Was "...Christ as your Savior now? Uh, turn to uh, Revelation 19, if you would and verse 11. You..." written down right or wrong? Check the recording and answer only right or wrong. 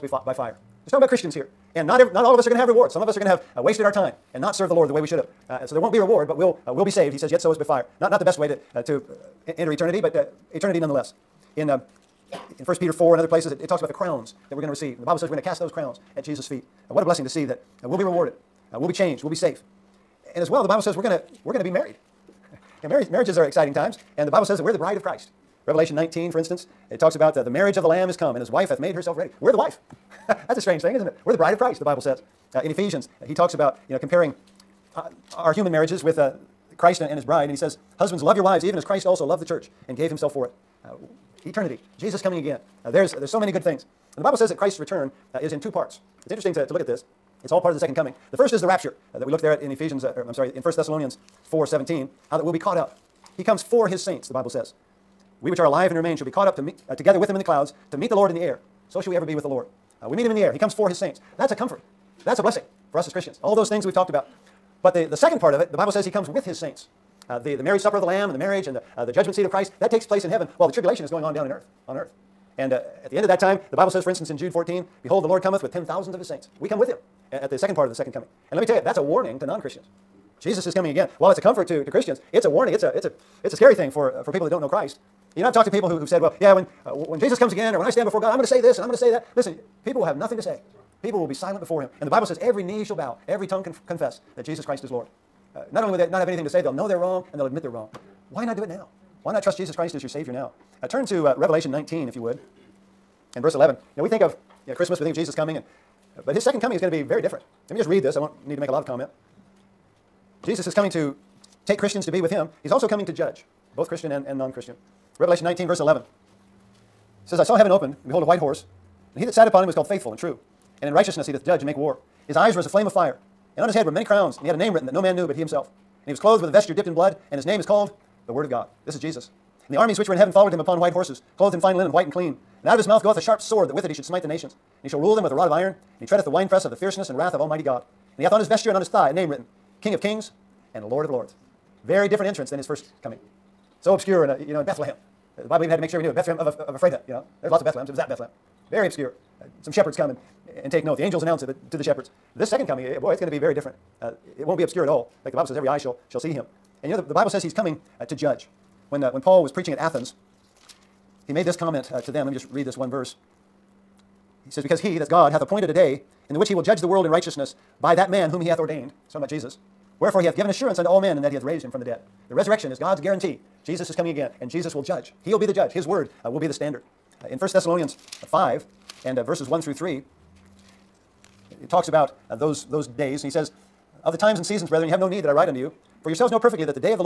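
right.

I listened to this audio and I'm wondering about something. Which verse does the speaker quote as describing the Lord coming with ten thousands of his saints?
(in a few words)
Jude 14.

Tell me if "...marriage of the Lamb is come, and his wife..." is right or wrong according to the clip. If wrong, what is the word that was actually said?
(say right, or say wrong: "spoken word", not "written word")
right.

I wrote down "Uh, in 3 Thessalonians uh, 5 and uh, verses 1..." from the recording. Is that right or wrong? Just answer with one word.
wrong.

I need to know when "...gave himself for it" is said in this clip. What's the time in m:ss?
0:39.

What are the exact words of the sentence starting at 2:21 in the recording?
Very different entrance than his first coming.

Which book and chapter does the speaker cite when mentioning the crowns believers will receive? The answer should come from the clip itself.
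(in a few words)
1 Peter 4.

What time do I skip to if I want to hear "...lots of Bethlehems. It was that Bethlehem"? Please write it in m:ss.
2:27.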